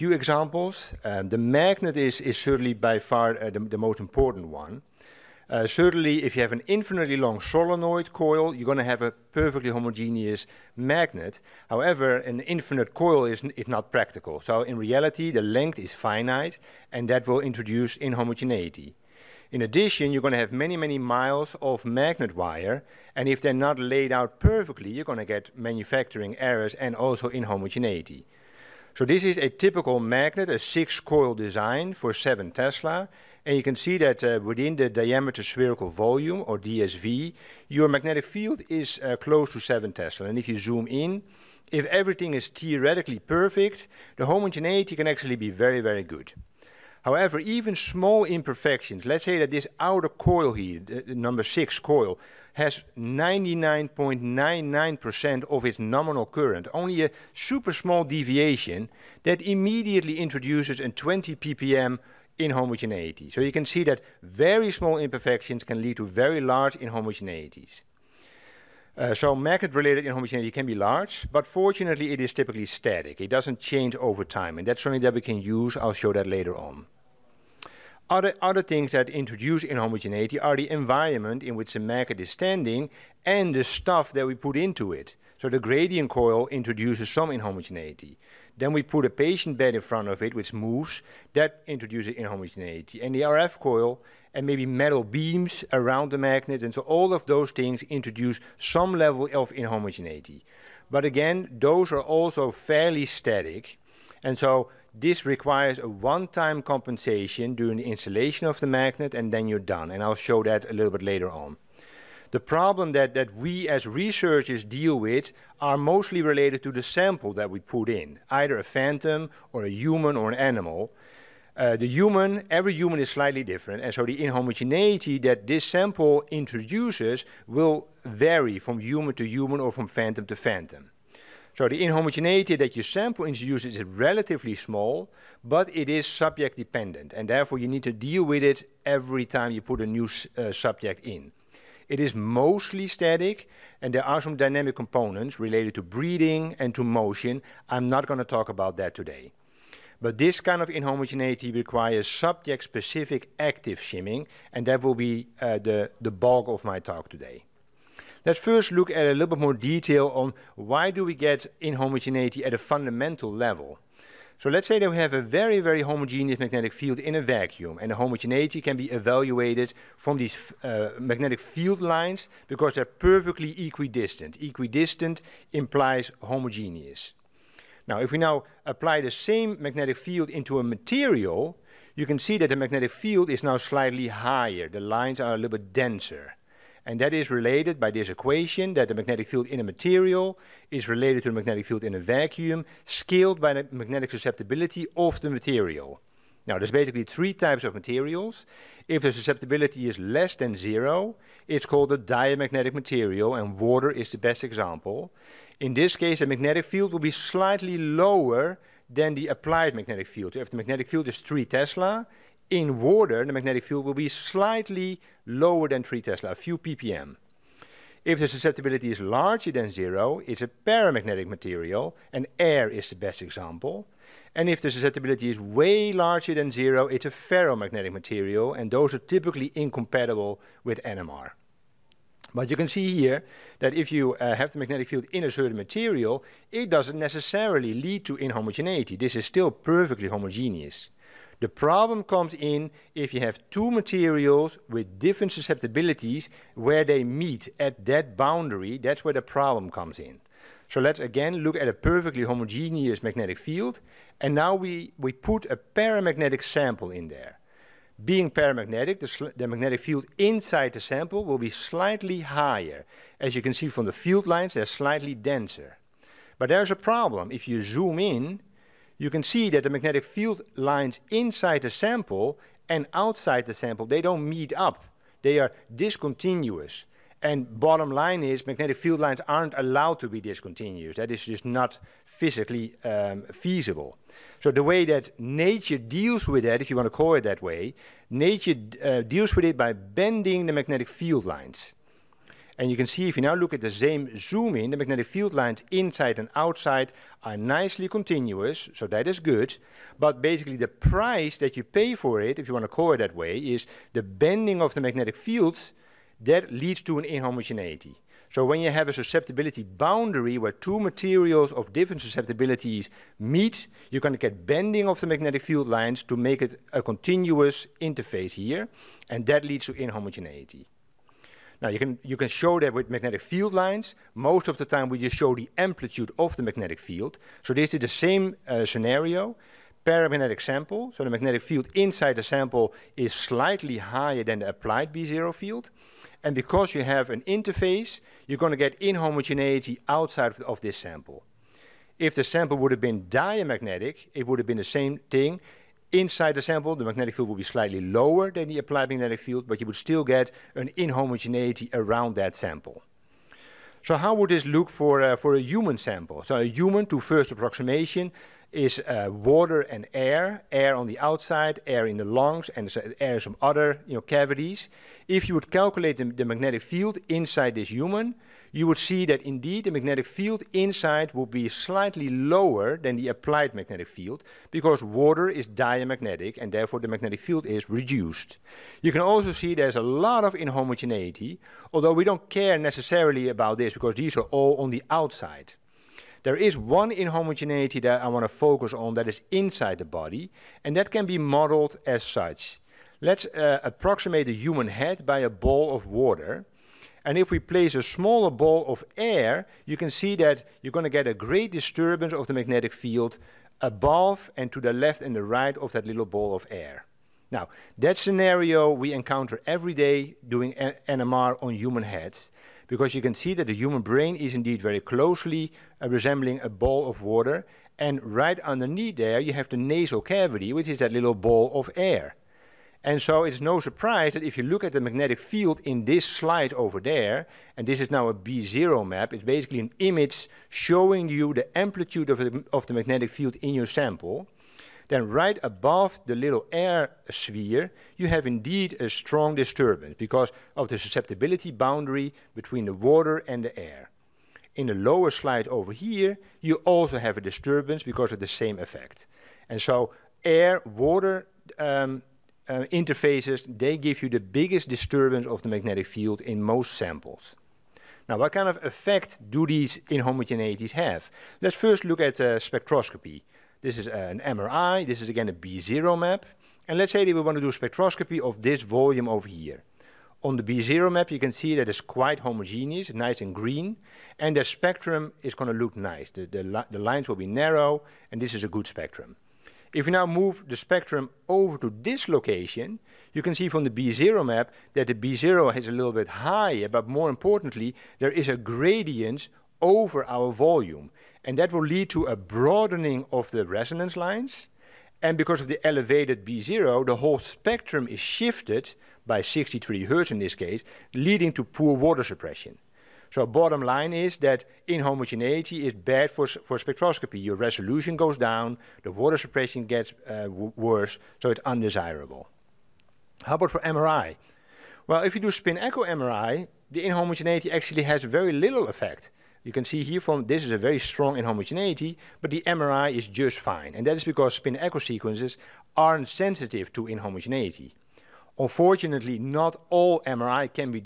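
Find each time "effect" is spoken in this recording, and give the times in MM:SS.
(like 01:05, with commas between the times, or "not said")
07:28, 07:38, 08:38.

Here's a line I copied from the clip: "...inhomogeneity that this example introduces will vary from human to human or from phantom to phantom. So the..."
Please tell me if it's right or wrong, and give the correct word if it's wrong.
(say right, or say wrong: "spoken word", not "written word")
wrong: "sample", not "example".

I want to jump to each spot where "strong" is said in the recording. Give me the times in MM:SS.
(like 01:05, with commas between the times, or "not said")
07:18, 08:40.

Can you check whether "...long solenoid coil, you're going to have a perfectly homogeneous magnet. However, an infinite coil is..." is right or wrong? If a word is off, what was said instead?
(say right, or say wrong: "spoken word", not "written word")
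right.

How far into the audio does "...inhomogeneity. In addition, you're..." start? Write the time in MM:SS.
00:17.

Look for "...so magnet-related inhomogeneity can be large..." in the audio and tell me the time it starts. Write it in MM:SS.
01:09.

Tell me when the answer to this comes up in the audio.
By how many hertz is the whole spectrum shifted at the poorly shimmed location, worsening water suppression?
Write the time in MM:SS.
08:19.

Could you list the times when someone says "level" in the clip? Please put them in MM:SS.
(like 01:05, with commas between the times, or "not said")
01:38, 02:43.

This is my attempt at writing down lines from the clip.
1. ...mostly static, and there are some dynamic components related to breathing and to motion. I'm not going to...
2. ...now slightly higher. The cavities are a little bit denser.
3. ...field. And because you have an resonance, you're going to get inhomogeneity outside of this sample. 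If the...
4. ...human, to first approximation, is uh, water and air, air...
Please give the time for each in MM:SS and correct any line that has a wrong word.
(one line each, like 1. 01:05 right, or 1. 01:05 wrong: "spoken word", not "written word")
1. 02:22 right
2. 03:03 wrong: "lines", not "cavities"
3. 05:35 wrong: "interface", not "resonance"
4. 05:56 right.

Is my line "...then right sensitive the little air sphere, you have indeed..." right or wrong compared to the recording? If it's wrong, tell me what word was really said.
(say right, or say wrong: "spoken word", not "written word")
wrong: "above", not "sensitive".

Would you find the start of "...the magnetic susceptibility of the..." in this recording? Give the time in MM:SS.
03:13.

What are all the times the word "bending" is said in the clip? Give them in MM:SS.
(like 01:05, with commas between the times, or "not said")
04:49, 05:04, 05:14.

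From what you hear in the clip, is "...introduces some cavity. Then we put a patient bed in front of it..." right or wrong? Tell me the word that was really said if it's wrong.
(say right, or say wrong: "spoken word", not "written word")
wrong: "inhomogeneity", not "cavity".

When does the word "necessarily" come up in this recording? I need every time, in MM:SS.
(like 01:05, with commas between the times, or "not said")
03:56, 06:22.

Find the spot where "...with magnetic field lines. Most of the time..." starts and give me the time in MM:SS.
05:22.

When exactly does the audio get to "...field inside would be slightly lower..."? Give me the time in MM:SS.
06:10.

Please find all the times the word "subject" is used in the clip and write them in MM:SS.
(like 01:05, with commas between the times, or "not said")
02:16, 02:20, 02:32.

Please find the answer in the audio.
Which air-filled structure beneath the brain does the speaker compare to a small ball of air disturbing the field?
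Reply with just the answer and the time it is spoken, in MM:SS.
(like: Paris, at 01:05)
Nasal cavity, at 06:59.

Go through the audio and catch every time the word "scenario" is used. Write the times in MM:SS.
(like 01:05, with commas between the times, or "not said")
05:28, 06:47.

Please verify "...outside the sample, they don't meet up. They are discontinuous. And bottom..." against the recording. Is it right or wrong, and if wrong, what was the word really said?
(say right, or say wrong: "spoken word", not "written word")
right.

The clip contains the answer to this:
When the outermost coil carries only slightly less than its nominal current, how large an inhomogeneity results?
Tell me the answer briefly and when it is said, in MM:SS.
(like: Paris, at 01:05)
20 ppm, at 01:00.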